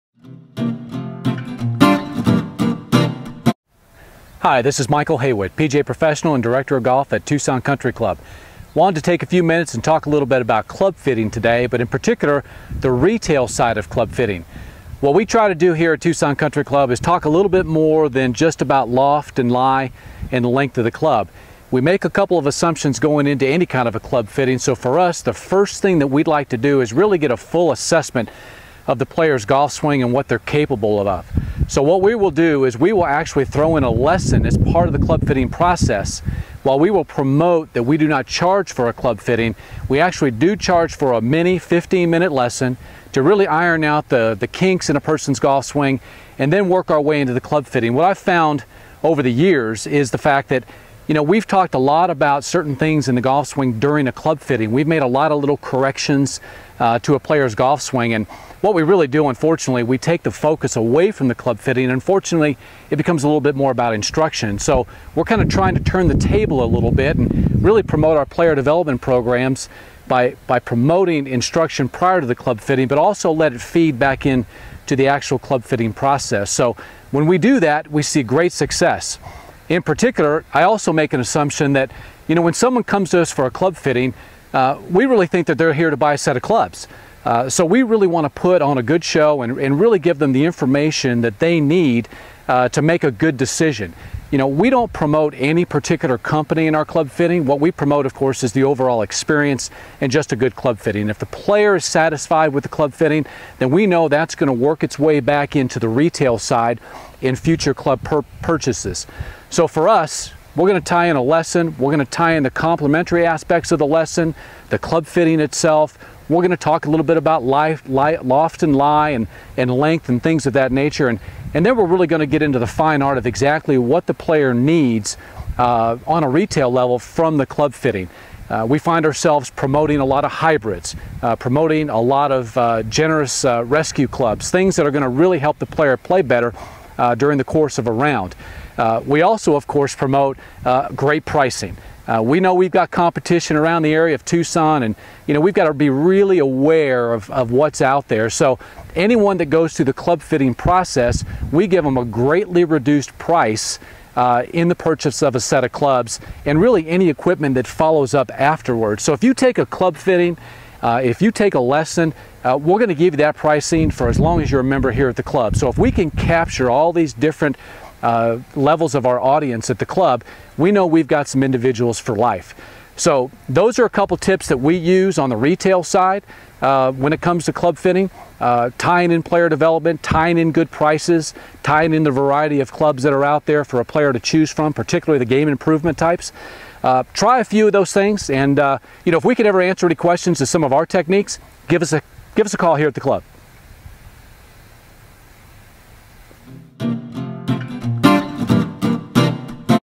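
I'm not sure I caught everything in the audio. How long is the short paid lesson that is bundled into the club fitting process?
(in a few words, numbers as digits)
15 minutes.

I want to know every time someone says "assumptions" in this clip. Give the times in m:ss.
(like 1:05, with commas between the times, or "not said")
0:22, 1:21.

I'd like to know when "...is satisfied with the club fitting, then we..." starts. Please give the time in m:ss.
1:41.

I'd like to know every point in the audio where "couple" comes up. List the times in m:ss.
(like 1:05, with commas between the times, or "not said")
0:22, 2:53.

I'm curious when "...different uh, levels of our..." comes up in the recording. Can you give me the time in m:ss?
2:47.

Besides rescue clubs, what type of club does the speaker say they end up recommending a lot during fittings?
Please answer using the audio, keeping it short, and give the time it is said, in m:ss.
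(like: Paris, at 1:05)
Hybrids, at 2:10.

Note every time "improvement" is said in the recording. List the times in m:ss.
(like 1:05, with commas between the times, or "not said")
3:05.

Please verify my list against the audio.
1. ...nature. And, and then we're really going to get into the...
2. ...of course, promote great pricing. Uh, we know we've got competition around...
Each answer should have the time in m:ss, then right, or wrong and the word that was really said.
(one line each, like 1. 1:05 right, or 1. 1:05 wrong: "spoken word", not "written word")
1. 2:00 right
2. 2:19 right.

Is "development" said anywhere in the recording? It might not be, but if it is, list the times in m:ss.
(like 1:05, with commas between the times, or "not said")
1:08, 2:59.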